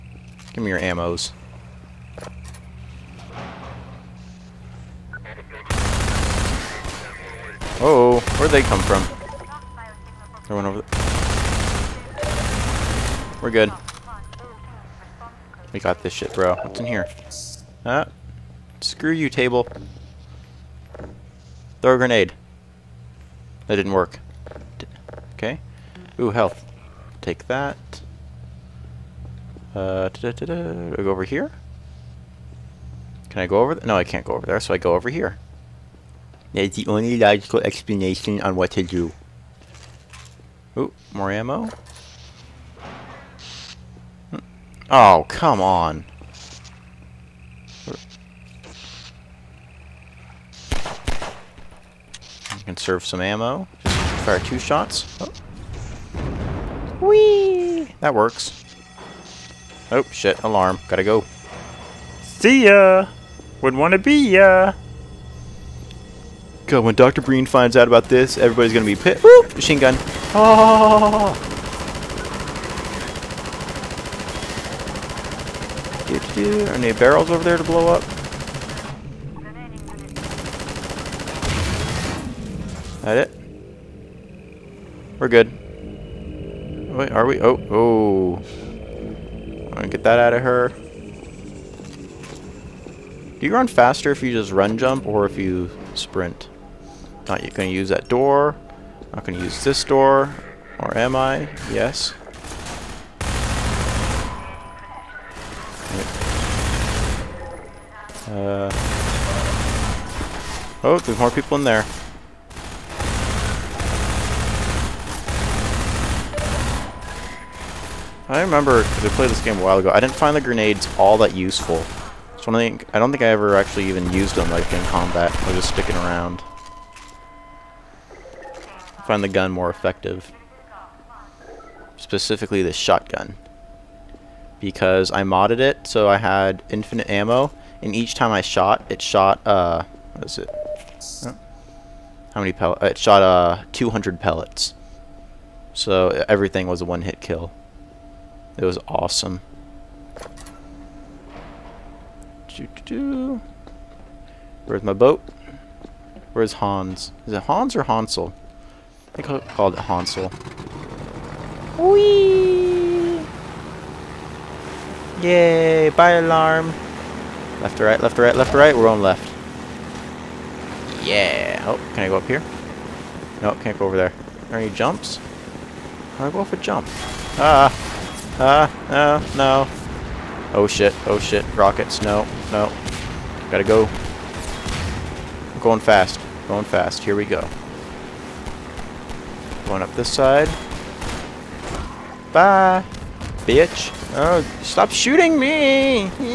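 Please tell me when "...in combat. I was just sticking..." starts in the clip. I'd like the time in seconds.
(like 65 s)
124 s.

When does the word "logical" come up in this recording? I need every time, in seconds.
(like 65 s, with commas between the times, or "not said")
37 s.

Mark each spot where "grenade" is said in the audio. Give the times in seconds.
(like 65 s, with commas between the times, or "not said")
21 s, 120 s.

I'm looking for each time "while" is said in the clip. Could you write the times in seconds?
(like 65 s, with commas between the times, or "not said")
119 s.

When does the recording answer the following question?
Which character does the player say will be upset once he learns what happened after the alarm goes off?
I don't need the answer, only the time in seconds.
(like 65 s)
66 s.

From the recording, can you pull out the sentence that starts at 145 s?
So everything was a one-hit kill.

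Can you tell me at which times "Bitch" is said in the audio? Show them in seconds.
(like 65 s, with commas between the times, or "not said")
193 s.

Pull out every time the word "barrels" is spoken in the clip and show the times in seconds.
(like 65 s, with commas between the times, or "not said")
76 s.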